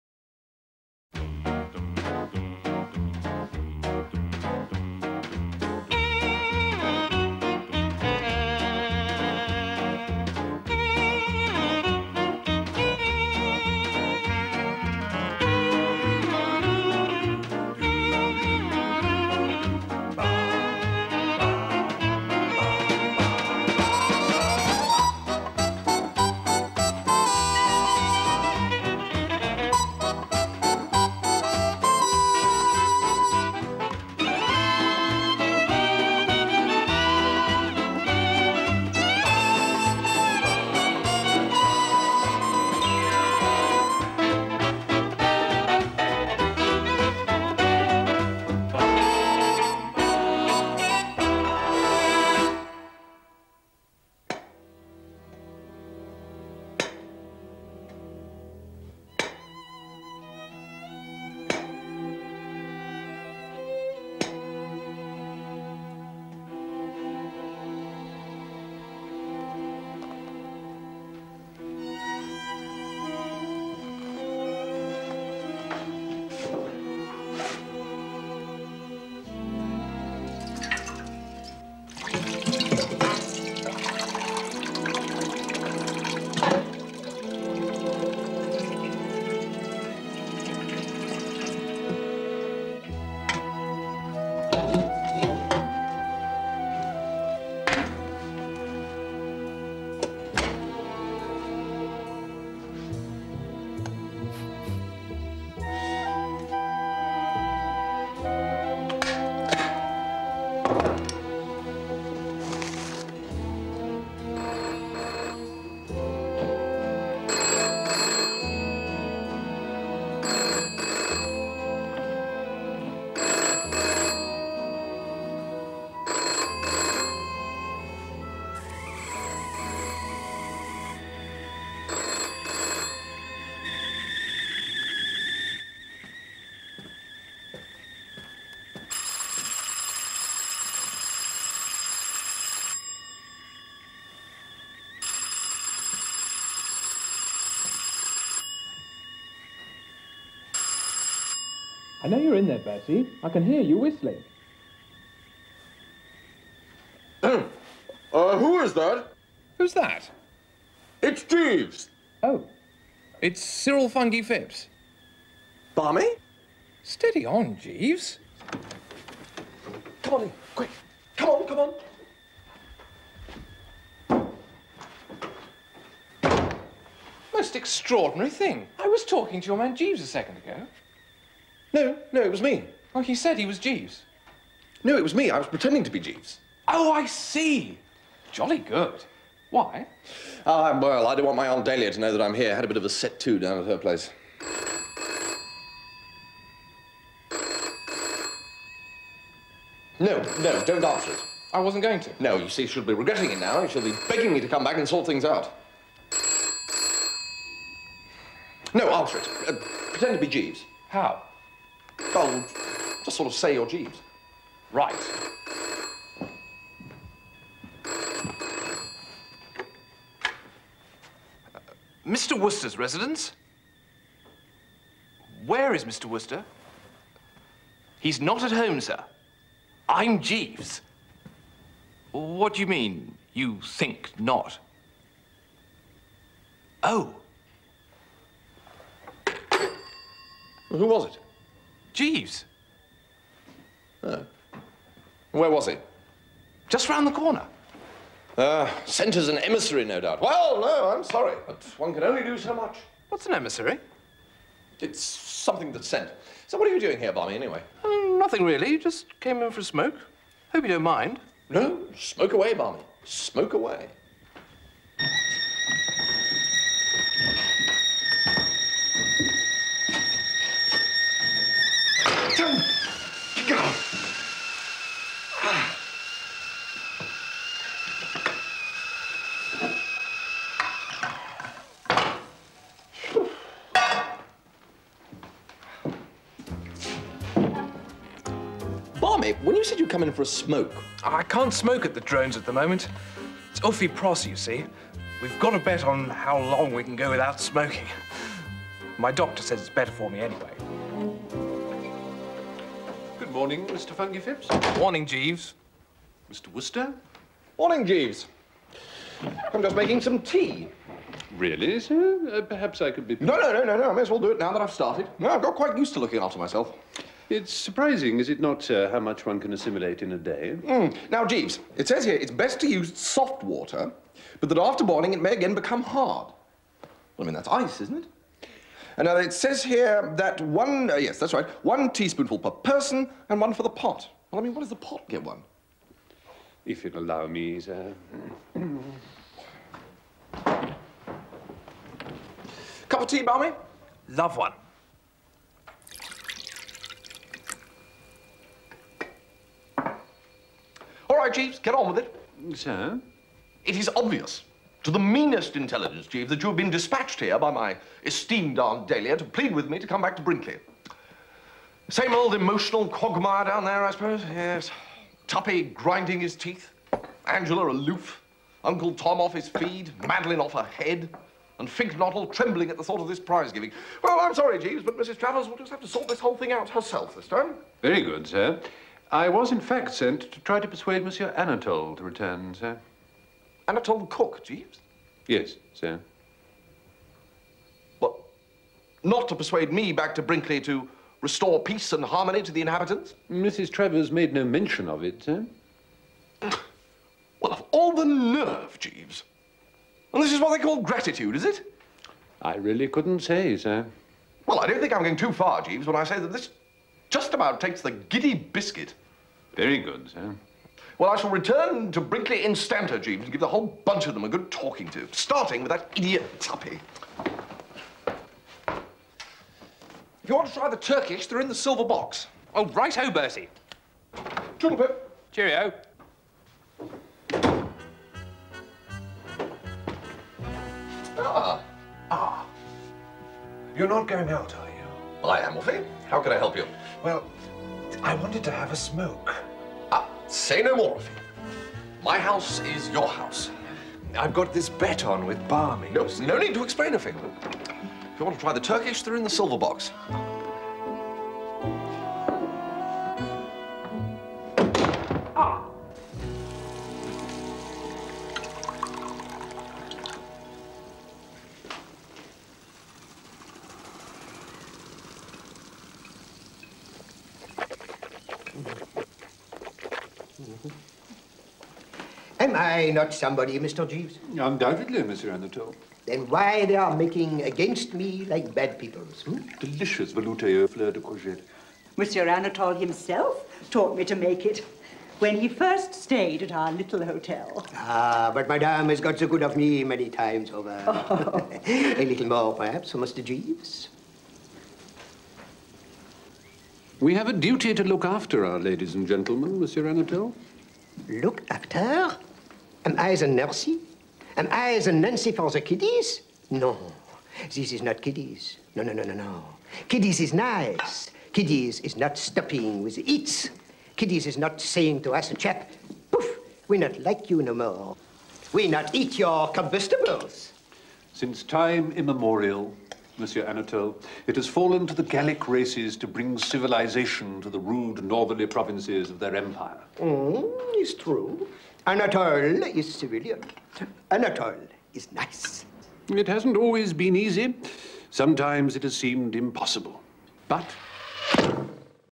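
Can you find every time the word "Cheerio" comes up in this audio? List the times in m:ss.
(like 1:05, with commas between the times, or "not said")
7:05.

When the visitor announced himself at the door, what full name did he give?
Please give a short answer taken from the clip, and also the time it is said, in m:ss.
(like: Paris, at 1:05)
Cyril Fungi Phipps, at 2:43.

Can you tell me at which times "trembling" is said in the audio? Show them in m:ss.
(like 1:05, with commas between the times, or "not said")
6:12.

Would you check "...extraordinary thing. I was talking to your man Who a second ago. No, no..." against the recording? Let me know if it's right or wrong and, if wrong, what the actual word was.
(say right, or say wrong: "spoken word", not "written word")
wrong: "Jeeves", not "Who".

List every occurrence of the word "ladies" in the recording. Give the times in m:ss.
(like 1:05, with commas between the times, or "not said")
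8:18.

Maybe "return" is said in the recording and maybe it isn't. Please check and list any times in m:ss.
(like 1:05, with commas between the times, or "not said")
6:22, 6:51.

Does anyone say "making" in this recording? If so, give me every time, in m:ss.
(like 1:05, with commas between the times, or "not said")
5:09, 7:56.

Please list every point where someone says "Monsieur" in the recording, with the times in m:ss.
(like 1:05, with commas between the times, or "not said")
6:21, 7:55, 8:01, 8:19, 8:43.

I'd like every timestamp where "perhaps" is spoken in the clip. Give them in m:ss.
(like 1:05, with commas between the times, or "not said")
5:12, 8:12.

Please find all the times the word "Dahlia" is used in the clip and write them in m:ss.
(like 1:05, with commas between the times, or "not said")
3:11, 5:58.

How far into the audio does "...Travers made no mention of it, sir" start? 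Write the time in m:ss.
6:33.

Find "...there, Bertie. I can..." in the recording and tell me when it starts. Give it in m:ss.
2:32.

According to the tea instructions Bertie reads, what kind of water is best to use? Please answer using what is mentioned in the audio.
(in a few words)
soft water.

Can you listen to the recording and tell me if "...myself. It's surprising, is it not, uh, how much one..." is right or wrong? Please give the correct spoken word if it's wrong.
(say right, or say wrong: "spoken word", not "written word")
right.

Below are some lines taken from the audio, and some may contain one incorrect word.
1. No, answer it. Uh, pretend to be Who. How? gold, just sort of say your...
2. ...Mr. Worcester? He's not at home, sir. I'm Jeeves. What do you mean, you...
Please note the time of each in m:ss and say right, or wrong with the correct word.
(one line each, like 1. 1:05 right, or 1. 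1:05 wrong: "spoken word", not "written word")
1. 3:28 wrong: "Jeeves", not "Who"
2. 3:45 right.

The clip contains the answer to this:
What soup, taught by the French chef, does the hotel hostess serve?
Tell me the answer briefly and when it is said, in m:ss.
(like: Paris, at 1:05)
velouté aux fleur de courgette, at 8:00.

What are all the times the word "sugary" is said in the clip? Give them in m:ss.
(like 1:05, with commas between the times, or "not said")
not said.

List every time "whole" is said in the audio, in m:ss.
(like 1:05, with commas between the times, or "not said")
6:16, 6:53.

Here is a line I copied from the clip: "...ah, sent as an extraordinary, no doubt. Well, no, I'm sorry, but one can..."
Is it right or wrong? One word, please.
wrong.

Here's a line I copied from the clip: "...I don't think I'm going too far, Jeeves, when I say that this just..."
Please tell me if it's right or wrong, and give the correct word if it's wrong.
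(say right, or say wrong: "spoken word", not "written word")
right.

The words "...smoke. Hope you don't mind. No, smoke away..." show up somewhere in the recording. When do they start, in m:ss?
4:19.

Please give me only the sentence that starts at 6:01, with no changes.
Same old emotional quagmire down there, I suppose.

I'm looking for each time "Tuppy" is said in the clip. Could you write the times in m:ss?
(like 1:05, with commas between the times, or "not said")
6:05, 6:56.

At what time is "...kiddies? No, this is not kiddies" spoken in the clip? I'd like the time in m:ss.
8:25.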